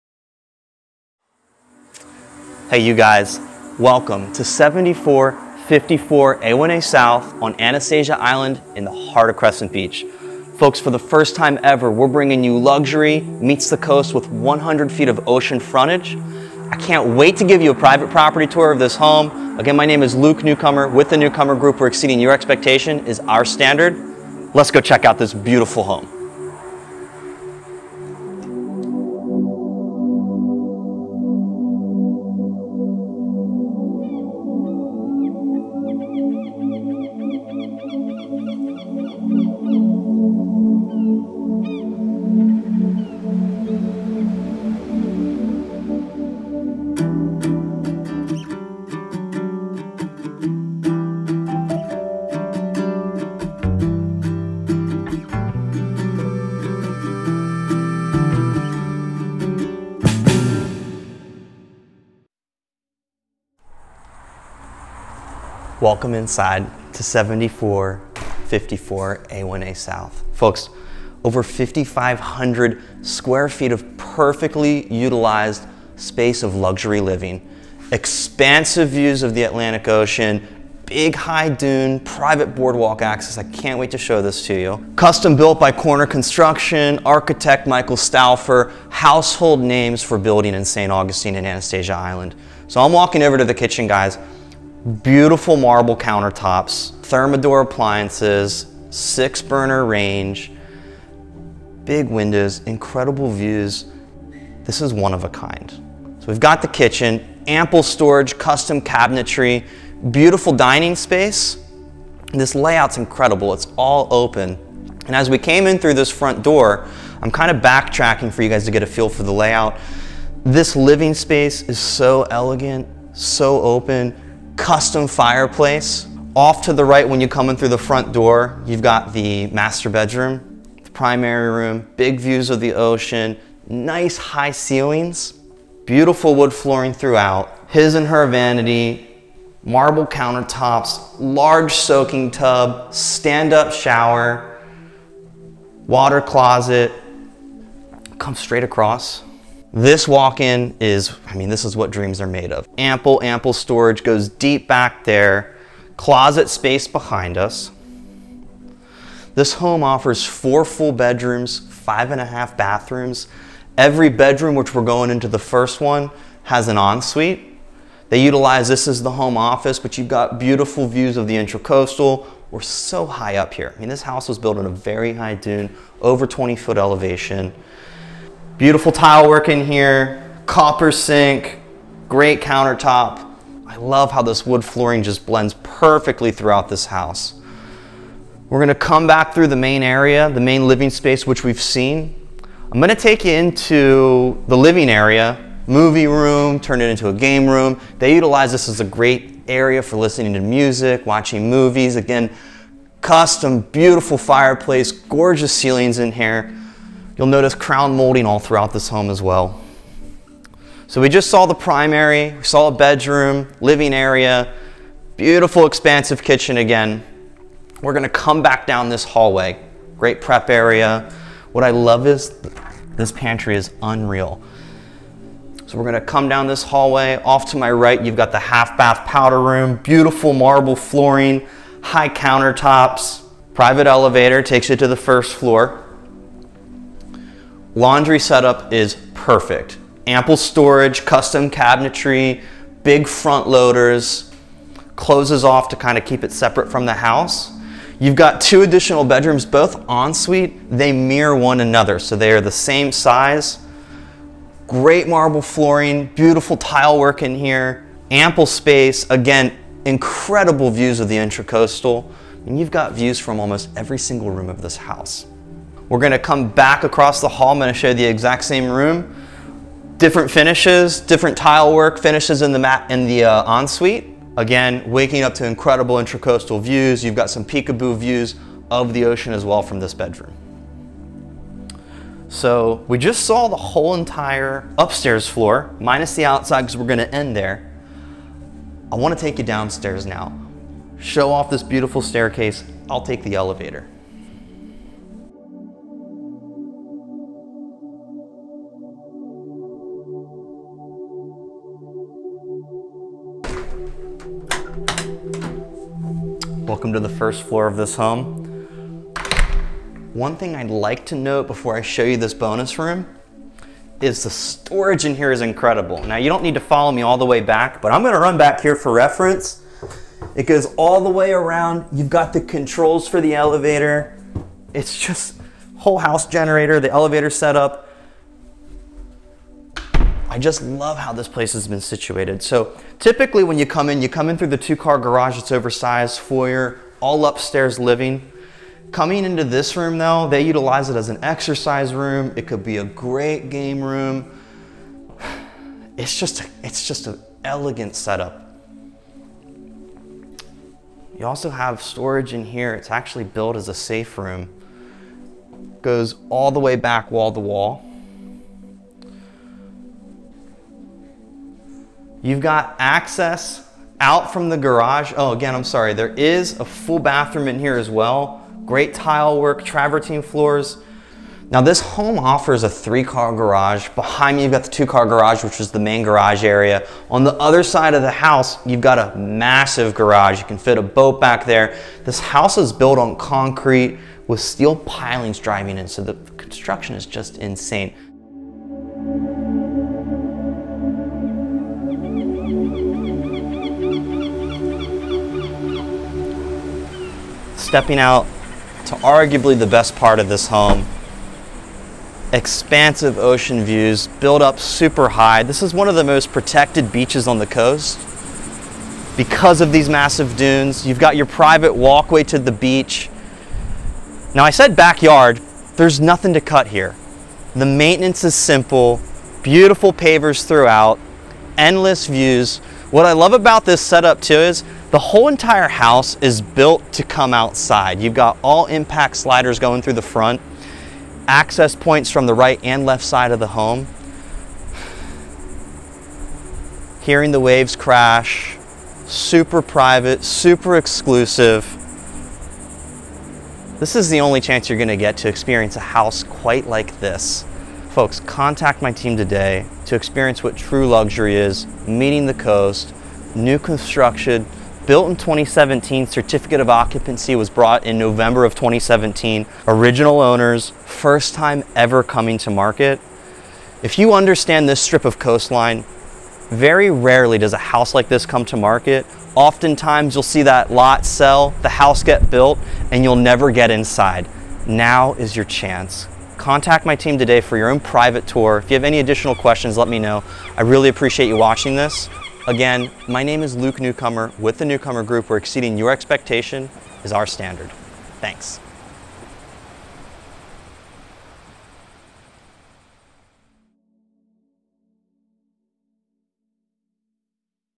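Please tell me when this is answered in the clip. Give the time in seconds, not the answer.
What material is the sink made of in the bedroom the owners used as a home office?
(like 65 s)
180 s.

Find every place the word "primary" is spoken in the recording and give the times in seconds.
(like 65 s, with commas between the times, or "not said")
130 s, 211 s.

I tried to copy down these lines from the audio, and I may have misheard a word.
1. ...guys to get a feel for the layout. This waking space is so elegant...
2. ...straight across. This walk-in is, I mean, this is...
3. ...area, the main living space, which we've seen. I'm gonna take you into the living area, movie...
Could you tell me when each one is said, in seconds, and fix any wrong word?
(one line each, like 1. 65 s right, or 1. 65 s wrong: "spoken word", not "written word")
1. 118 s wrong: "living", not "waking"
2. 148 s right
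3. 189 s right.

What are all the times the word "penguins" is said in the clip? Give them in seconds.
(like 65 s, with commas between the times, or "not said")
not said.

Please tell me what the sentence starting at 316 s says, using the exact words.
Now you don't need to follow me all the way back, but I'm gonna run back here for reference.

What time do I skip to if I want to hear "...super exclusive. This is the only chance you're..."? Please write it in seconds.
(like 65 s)
440 s.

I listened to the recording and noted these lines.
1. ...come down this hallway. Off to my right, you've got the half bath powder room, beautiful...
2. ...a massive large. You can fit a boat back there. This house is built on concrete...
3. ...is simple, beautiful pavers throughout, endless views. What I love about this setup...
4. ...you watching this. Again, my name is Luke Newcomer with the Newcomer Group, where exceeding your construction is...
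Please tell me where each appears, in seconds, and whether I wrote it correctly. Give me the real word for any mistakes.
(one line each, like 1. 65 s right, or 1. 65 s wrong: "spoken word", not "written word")
1. 226 s right
2. 378 s wrong: "garage", not "large"
3. 418 s right
4. 481 s wrong: "expectation", not "construction".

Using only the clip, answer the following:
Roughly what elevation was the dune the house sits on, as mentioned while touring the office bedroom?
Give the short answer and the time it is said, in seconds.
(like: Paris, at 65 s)
Over 20 feet, at 176 s.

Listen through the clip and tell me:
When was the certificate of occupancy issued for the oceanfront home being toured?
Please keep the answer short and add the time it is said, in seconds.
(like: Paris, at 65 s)
November 2017, at 457 s.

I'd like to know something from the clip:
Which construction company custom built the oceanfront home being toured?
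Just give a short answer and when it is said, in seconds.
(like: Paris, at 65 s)
Corner Construction, at 85 s.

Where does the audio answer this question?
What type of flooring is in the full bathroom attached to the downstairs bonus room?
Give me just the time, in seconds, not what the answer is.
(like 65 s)
369 s.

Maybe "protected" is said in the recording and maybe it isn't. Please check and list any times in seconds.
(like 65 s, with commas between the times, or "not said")
406 s.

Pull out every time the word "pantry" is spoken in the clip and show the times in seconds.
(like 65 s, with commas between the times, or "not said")
223 s.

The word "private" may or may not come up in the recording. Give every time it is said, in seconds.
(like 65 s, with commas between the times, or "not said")
17 s, 82 s, 233 s, 411 s, 439 s, 477 s.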